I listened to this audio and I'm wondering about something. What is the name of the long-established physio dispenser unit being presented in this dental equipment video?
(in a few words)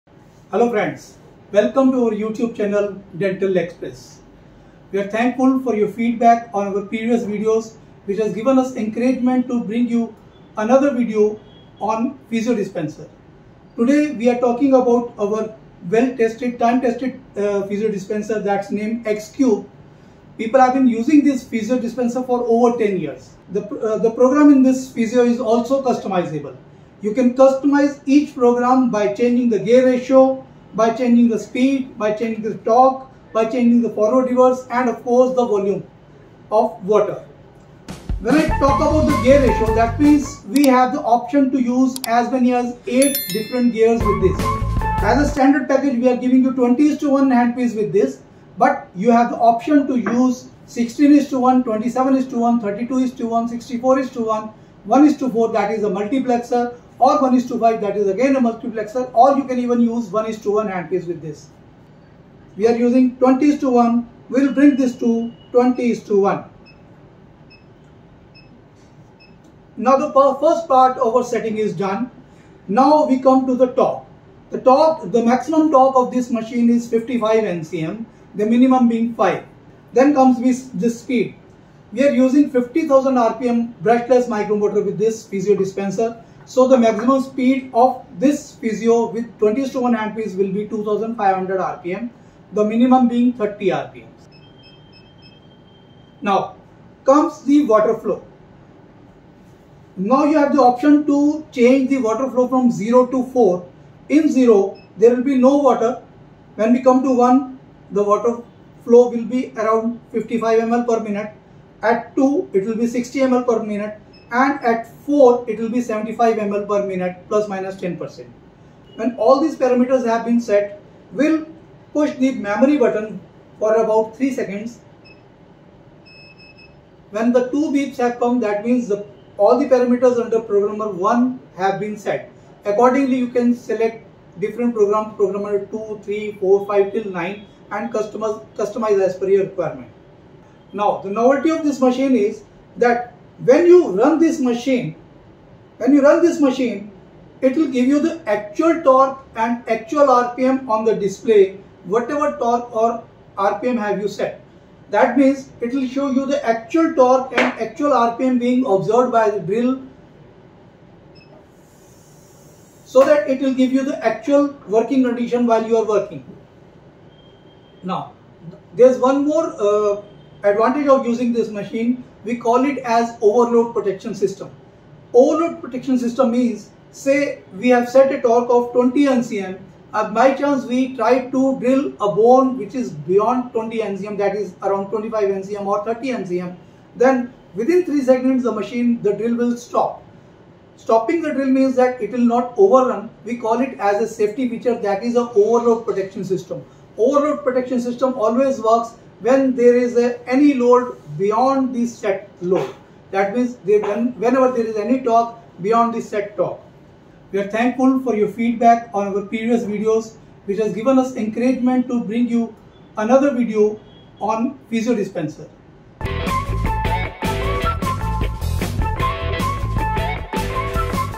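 X-Cube.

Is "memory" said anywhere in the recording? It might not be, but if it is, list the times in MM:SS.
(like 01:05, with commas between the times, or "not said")
02:02.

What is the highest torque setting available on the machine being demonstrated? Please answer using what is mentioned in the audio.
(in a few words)
55 NCM.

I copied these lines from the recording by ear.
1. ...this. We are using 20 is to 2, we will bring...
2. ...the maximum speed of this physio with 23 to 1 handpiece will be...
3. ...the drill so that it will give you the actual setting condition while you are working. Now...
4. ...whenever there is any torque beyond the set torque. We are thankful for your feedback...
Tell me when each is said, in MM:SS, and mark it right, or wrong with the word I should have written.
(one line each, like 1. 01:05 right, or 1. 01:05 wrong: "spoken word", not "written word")
1. 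01:01 wrong: "1", not "2"
2. 01:26 wrong: "20", not "23"
3. 02:39 wrong: "working", not "setting"
4. 03:23 right.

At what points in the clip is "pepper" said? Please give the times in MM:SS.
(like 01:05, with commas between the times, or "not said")
not said.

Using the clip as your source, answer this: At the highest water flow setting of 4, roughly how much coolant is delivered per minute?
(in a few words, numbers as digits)
75 ml.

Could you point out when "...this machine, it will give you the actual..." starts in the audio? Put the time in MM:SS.
02:26.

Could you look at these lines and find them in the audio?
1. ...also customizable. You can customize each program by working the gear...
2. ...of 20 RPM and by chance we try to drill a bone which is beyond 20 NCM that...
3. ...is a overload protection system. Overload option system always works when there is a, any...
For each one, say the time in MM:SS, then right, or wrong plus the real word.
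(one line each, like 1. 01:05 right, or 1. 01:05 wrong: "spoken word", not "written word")
1. 00:25 wrong: "changing", not "working"
2. 02:58 wrong: "NCM", not "RPM"
3. 03:15 wrong: "protection", not "option".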